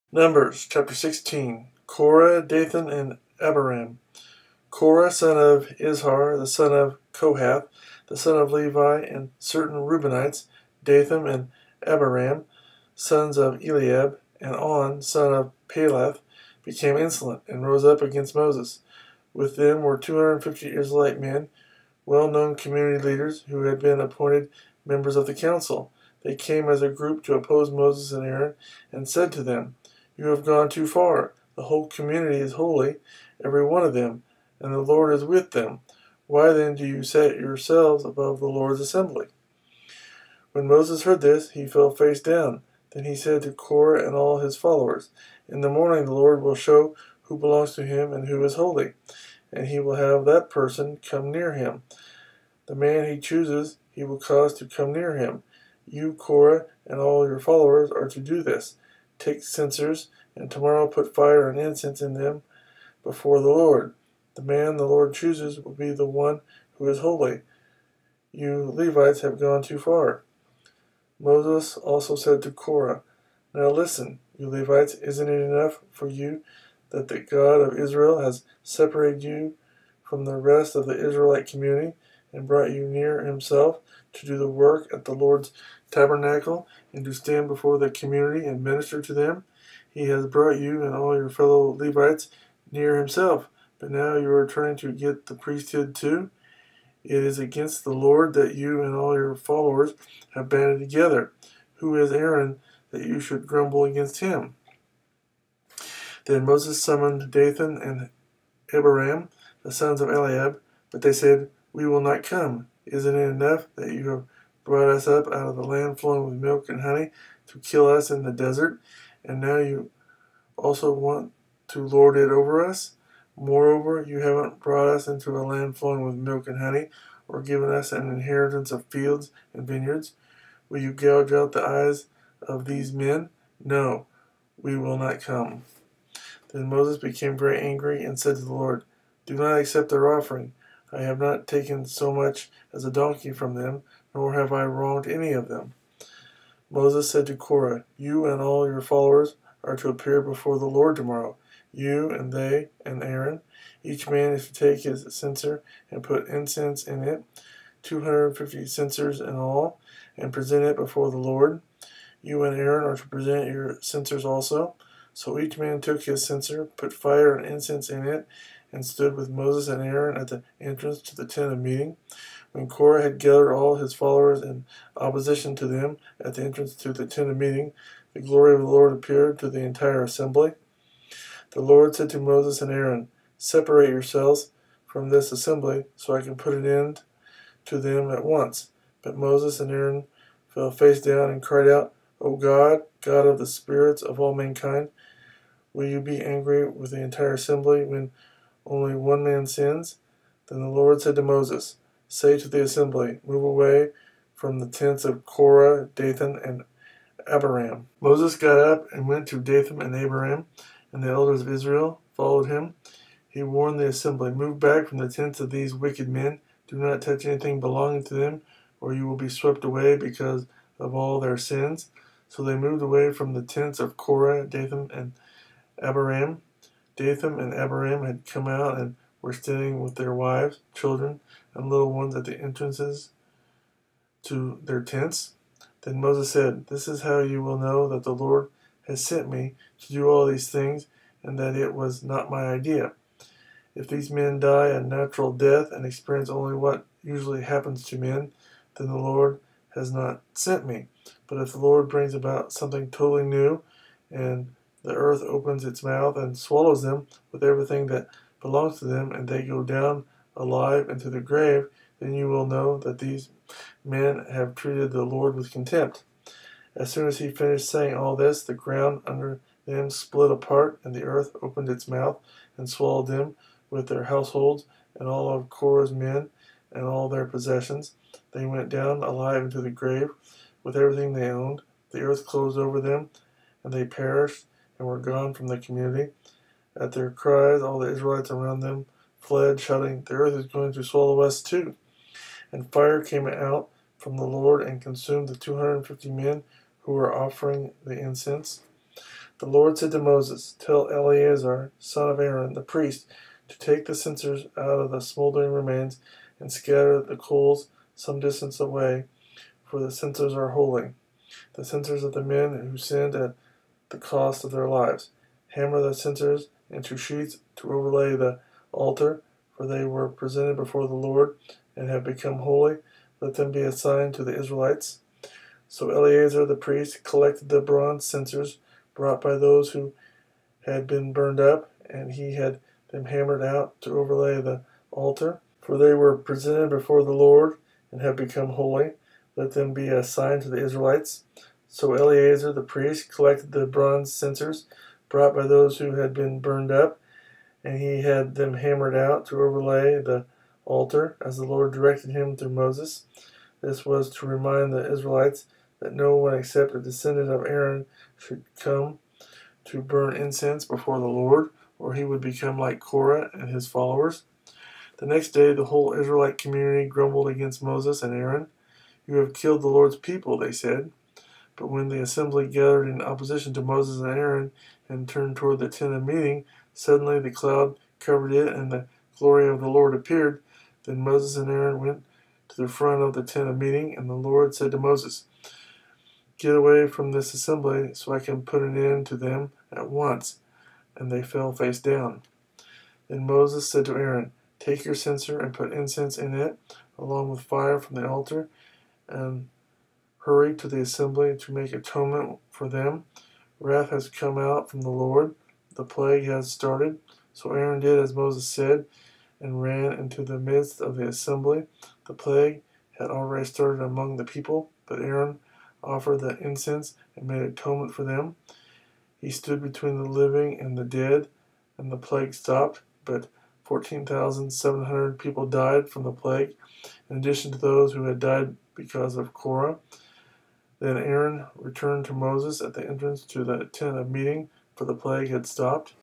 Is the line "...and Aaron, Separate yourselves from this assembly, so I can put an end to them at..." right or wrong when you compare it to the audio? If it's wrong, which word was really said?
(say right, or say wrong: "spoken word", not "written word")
right.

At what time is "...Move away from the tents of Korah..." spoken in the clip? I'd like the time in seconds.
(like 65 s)
203 s.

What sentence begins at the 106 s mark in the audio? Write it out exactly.
Then Moses summoned Dathan and Abiram, the sons of Eliab, but they said, we will not come.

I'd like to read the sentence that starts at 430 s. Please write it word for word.
Then Aaron returned to Moses at the entrance to the tent of meeting, for the plague had stopped.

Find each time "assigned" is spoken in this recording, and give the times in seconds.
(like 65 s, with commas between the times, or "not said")
323 s, 339 s.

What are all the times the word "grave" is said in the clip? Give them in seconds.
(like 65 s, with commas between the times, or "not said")
261 s, 279 s.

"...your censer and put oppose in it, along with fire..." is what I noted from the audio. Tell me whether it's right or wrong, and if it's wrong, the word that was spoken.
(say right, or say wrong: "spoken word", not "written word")
wrong: "incense", not "oppose".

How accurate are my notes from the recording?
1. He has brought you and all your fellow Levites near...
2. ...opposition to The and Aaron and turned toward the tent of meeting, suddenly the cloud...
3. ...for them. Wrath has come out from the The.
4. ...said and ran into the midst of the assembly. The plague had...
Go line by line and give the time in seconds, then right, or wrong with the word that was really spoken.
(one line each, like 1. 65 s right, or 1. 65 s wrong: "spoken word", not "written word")
1. 89 s right
2. 373 s wrong: "Moses", not "The"
3. 402 s wrong: "Lord", not "The"
4. 408 s right.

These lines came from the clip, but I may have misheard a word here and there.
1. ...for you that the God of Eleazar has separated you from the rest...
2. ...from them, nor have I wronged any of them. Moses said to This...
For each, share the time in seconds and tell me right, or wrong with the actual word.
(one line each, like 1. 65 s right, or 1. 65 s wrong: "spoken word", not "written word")
1. 75 s wrong: "Israel", not "Eleazar"
2. 143 s wrong: "Korah", not "This".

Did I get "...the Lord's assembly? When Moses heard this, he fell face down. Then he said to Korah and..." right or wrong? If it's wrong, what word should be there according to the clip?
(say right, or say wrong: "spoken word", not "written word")
right.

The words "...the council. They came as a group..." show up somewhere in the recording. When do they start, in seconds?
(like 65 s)
25 s.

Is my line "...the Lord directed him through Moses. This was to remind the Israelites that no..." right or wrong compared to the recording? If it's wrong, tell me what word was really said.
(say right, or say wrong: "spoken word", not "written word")
right.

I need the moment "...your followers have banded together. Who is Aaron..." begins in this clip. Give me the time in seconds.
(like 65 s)
99 s.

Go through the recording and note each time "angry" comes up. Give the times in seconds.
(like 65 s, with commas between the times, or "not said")
137 s, 196 s.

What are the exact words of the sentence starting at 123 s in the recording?
Moreover, you haven't brought us into a land flowing with milk and honey, or given us an inheritance of fields and vineyards.